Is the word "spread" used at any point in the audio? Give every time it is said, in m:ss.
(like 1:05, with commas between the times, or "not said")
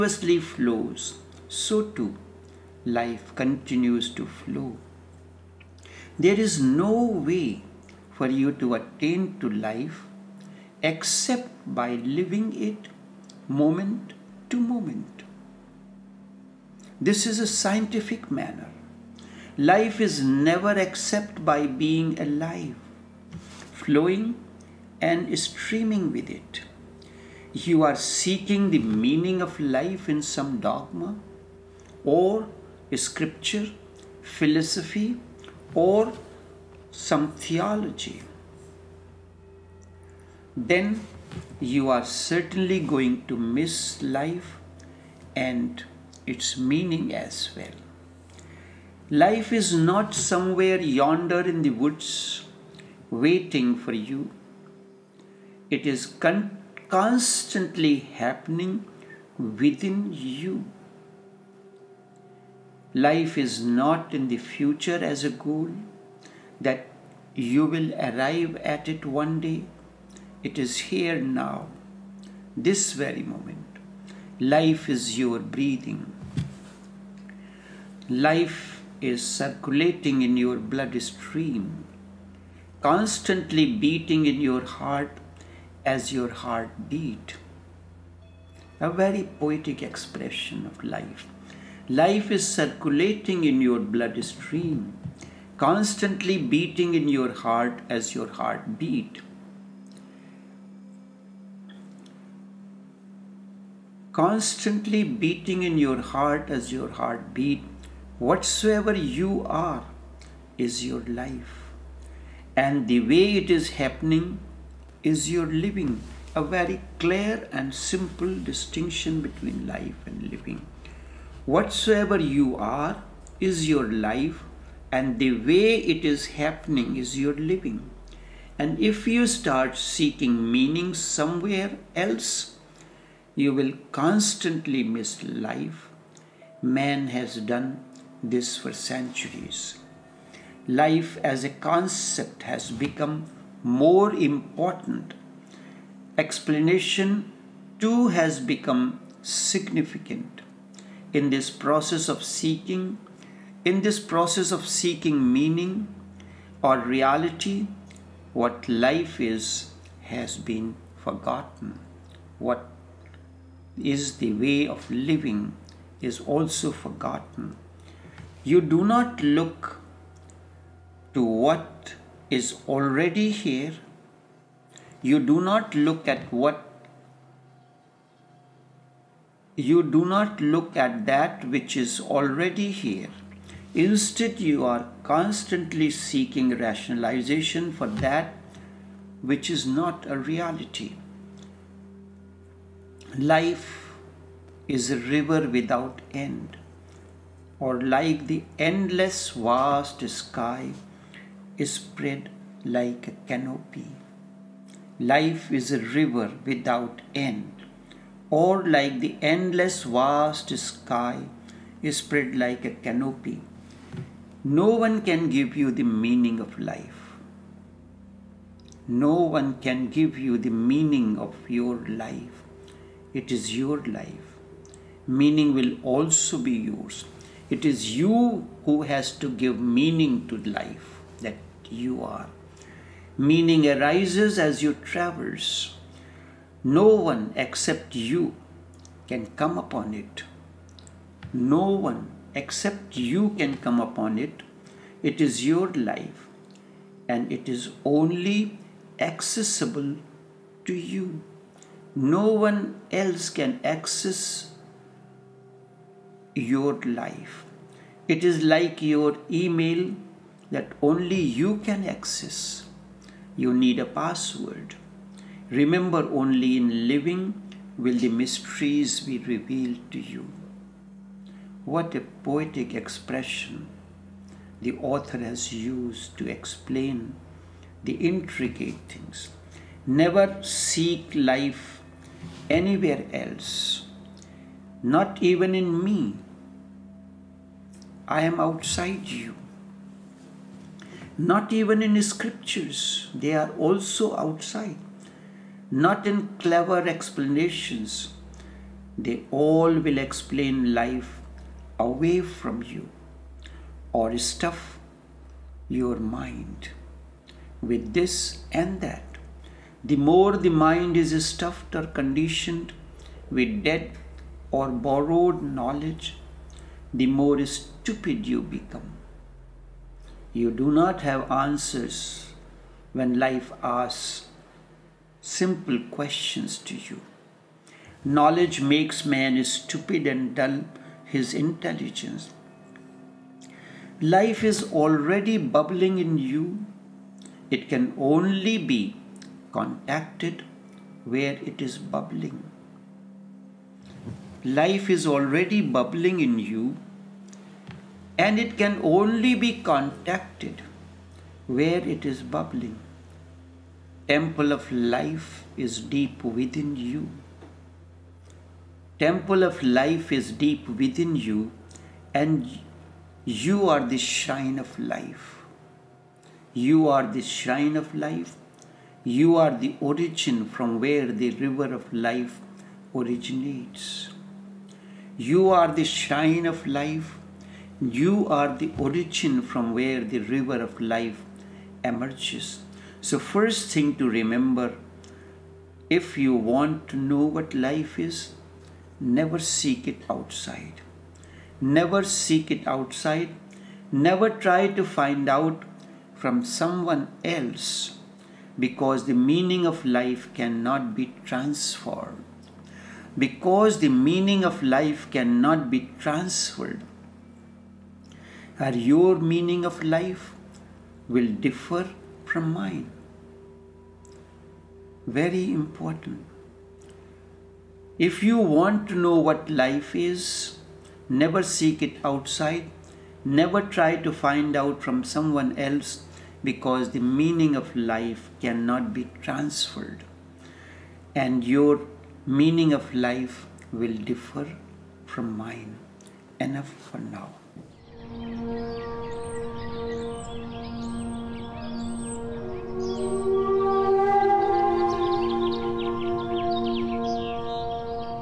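3:21, 3:31.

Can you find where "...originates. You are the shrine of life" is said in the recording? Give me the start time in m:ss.
6:12.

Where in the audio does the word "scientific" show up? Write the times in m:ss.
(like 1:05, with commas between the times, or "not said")
0:17.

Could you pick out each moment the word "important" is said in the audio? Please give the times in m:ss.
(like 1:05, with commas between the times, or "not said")
2:24, 6:55.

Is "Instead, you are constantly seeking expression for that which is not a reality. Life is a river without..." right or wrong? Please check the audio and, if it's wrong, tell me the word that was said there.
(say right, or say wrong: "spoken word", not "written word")
wrong: "rationalization", not "expression".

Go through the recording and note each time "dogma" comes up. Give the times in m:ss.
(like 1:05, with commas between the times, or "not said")
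0:30.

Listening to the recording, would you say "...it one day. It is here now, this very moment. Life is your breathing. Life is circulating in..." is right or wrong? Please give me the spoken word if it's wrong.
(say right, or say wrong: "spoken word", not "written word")
right.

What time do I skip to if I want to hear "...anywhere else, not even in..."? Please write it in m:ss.
4:42.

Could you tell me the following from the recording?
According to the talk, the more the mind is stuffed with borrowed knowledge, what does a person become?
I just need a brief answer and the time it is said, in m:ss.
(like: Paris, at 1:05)
more stupid, at 5:17.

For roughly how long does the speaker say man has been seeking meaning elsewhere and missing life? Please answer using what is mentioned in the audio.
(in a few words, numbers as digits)
centuries.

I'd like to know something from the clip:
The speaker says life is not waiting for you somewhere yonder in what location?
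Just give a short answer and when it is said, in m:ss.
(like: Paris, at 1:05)
the woods, at 0:51.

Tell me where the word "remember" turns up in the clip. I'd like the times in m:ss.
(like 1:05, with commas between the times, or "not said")
4:25, 6:24.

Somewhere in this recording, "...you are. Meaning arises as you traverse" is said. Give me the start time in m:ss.
3:51.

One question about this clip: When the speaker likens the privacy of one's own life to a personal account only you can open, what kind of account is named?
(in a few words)
email.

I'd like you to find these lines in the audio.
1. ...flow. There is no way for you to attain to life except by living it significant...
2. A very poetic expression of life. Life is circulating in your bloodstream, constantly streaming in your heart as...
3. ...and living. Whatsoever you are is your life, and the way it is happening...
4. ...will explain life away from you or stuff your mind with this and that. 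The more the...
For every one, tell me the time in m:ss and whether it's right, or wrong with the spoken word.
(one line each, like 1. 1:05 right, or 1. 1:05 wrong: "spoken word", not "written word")
1. 0:04 wrong: "moment", not "significant"
2. 1:28 wrong: "beating", not "streaming"
3. 2:00 right
4. 4:59 right.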